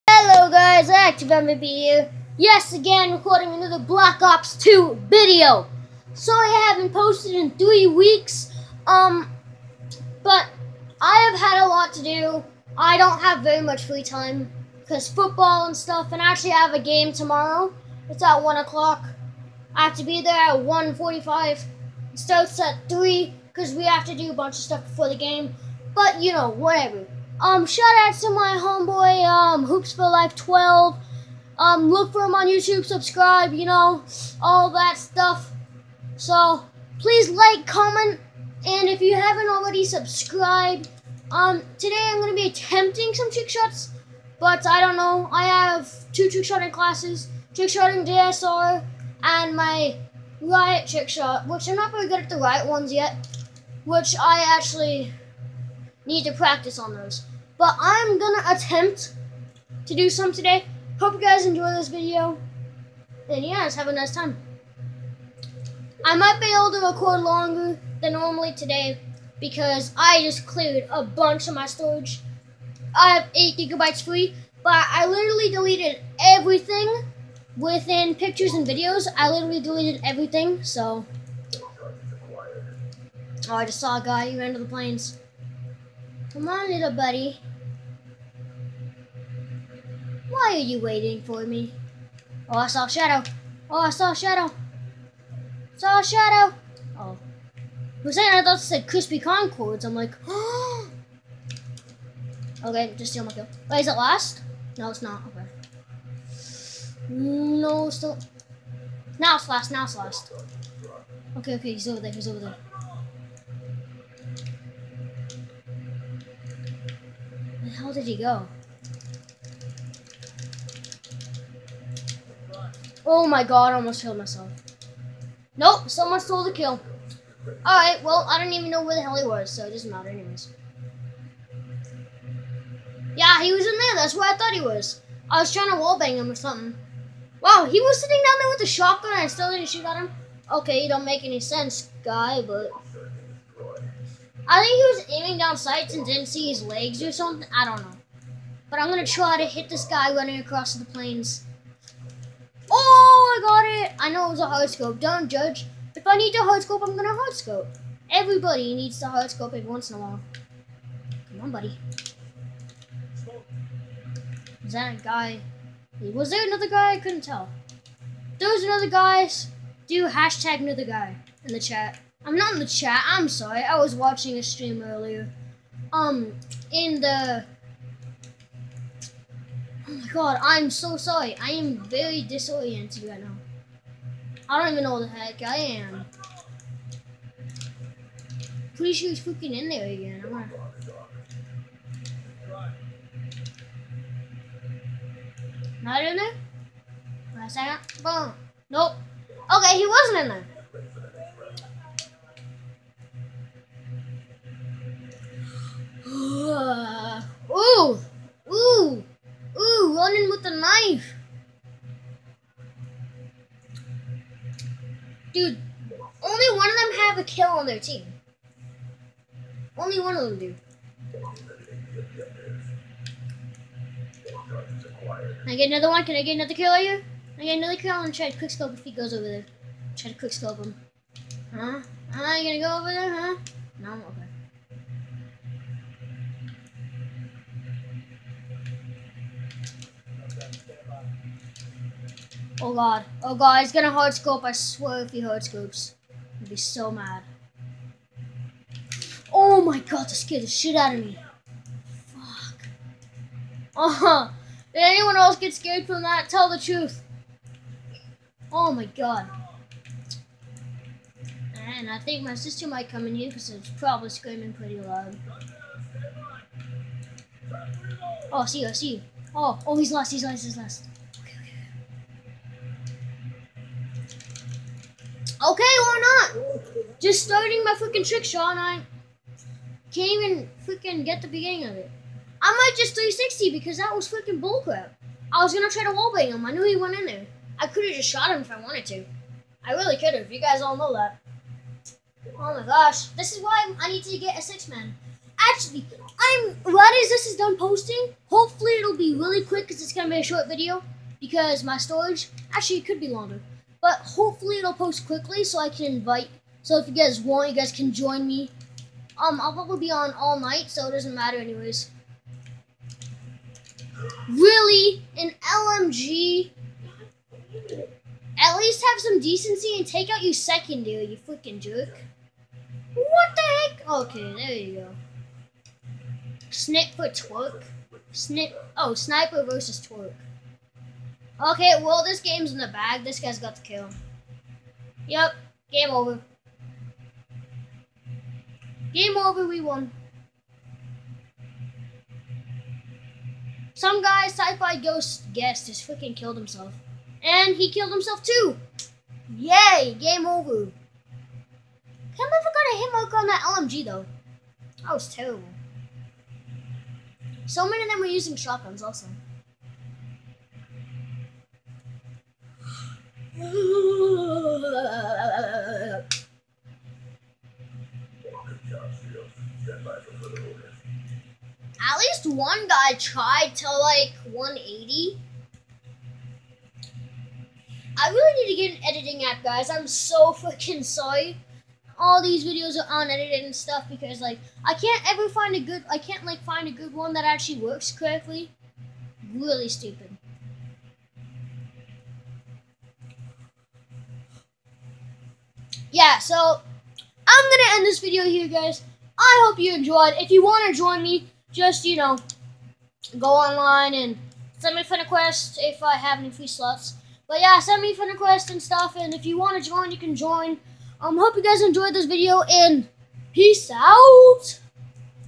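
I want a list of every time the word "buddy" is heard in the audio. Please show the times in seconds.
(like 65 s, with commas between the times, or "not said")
86 s, 161 s.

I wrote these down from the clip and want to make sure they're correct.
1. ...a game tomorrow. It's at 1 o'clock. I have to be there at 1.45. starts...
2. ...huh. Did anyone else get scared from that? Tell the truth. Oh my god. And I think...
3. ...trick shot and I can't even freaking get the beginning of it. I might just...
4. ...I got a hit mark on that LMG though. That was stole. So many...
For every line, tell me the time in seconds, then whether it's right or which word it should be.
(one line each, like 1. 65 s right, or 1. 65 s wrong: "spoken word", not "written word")
1. 16 s right
2. 253 s right
3. 278 s right
4. 352 s wrong: "terrible", not "stole".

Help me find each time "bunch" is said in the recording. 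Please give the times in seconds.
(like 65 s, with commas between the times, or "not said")
24 s, 71 s.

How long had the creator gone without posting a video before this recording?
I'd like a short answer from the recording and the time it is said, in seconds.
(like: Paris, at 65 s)
3 weeks, at 7 s.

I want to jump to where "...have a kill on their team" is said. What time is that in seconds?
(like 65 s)
216 s.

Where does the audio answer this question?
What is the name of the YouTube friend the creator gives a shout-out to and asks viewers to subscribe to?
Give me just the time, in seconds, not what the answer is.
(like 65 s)
29 s.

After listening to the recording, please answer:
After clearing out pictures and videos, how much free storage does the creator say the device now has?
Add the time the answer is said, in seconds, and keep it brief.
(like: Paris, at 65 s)
8 gigabytes, at 73 s.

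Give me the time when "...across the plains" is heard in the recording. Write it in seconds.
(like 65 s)
150 s.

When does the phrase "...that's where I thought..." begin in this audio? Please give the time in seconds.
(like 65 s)
133 s.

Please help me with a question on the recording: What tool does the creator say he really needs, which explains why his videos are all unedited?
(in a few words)
An editing app.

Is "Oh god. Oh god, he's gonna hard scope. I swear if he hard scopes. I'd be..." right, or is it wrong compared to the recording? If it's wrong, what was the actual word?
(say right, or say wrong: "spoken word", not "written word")
right.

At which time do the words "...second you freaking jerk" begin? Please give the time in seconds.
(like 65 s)
320 s.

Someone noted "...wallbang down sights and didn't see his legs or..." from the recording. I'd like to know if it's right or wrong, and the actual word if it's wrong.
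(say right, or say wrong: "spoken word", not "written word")
wrong: "aiming", not "wallbang".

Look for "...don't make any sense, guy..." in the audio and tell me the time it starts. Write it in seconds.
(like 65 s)
140 s.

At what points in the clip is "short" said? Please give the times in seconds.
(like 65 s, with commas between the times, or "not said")
300 s.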